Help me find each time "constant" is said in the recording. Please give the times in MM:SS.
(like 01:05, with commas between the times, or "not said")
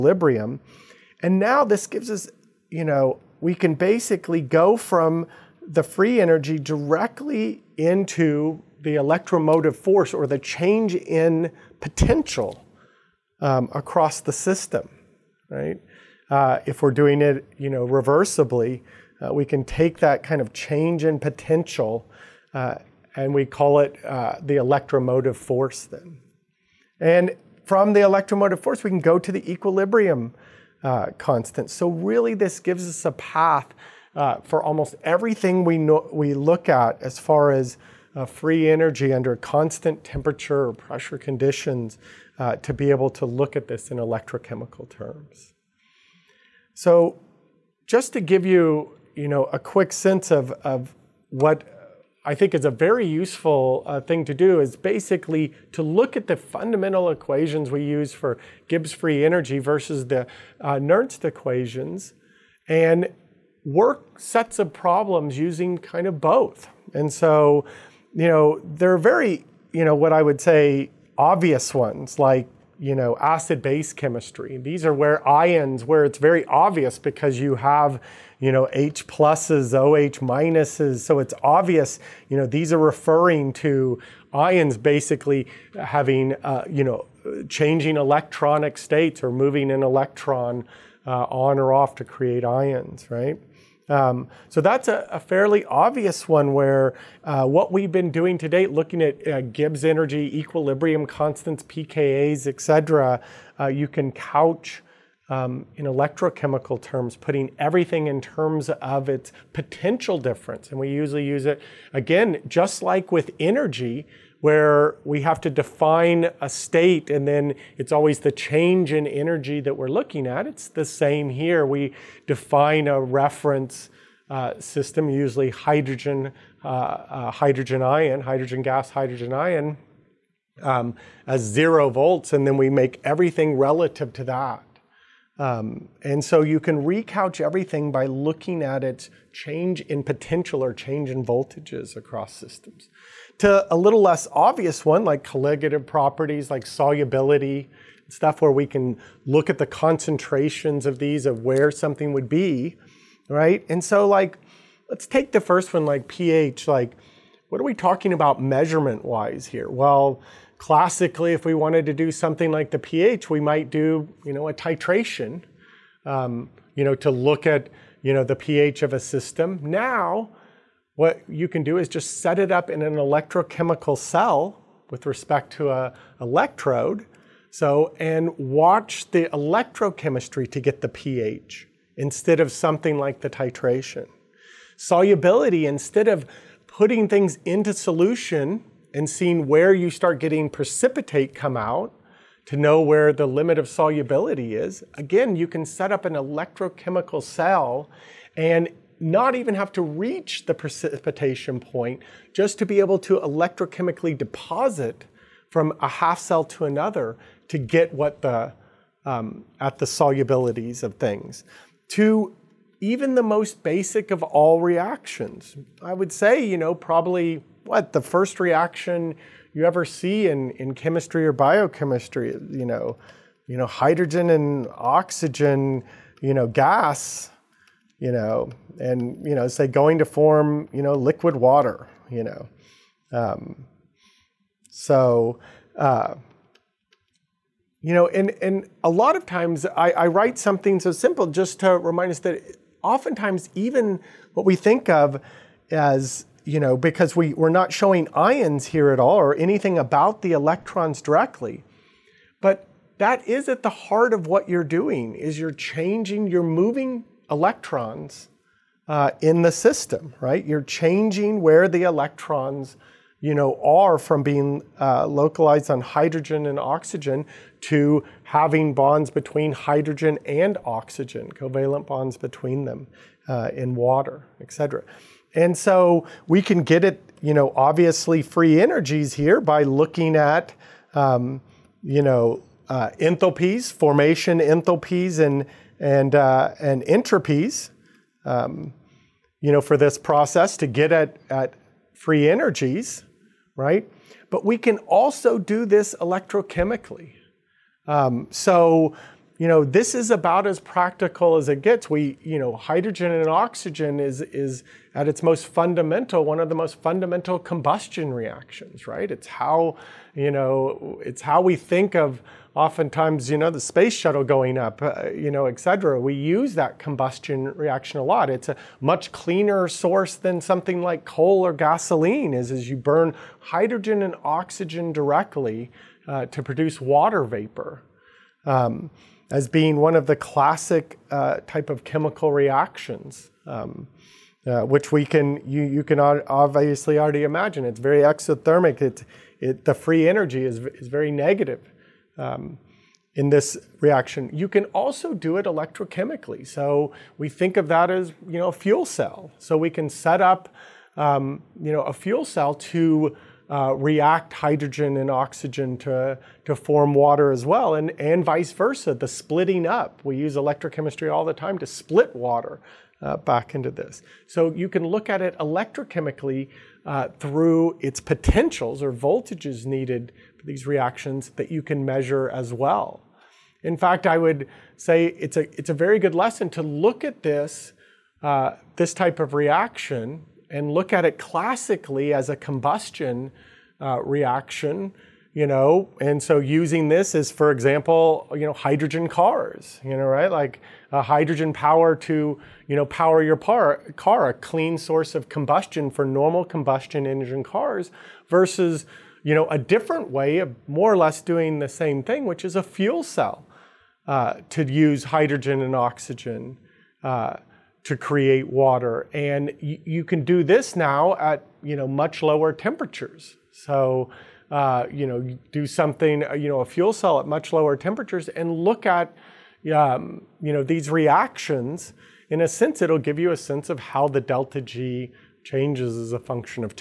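00:31, 00:39, 01:41.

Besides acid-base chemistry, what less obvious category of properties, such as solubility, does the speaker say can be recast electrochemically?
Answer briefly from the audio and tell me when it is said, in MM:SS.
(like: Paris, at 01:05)
colligative properties, at 02:25.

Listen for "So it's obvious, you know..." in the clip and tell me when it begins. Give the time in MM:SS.
01:20.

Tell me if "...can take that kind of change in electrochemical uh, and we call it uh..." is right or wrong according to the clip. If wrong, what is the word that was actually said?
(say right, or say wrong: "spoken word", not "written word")
wrong: "potential", not "electrochemical".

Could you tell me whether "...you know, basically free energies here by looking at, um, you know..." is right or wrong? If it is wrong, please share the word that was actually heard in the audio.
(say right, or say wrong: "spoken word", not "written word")
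wrong: "obviously", not "basically".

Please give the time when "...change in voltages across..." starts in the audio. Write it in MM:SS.
02:20.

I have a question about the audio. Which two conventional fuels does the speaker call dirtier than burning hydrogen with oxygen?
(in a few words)
coal or gasoline.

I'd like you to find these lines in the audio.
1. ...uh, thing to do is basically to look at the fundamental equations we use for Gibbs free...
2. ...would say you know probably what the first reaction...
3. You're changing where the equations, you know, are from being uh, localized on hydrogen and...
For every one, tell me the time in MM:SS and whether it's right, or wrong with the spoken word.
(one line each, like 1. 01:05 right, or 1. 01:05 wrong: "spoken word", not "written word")
1. 00:53 right
2. 03:35 right
3. 04:20 wrong: "electrons", not "equations".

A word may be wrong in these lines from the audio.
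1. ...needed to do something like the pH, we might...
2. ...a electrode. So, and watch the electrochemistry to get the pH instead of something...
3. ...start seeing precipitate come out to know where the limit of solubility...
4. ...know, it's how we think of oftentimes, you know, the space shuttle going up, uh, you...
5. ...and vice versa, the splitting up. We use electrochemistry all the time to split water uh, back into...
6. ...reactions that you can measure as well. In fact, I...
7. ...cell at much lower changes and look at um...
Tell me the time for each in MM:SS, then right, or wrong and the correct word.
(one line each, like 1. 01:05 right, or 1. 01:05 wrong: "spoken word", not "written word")
1. 02:41 wrong: "wanted", not "needed"
2. 02:55 right
3. 03:09 wrong: "getting", not "seeing"
4. 05:10 right
5. 05:57 right
6. 06:10 right
7. 06:56 wrong: "temperatures", not "changes".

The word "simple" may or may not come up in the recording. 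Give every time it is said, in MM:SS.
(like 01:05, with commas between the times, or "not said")
04:00.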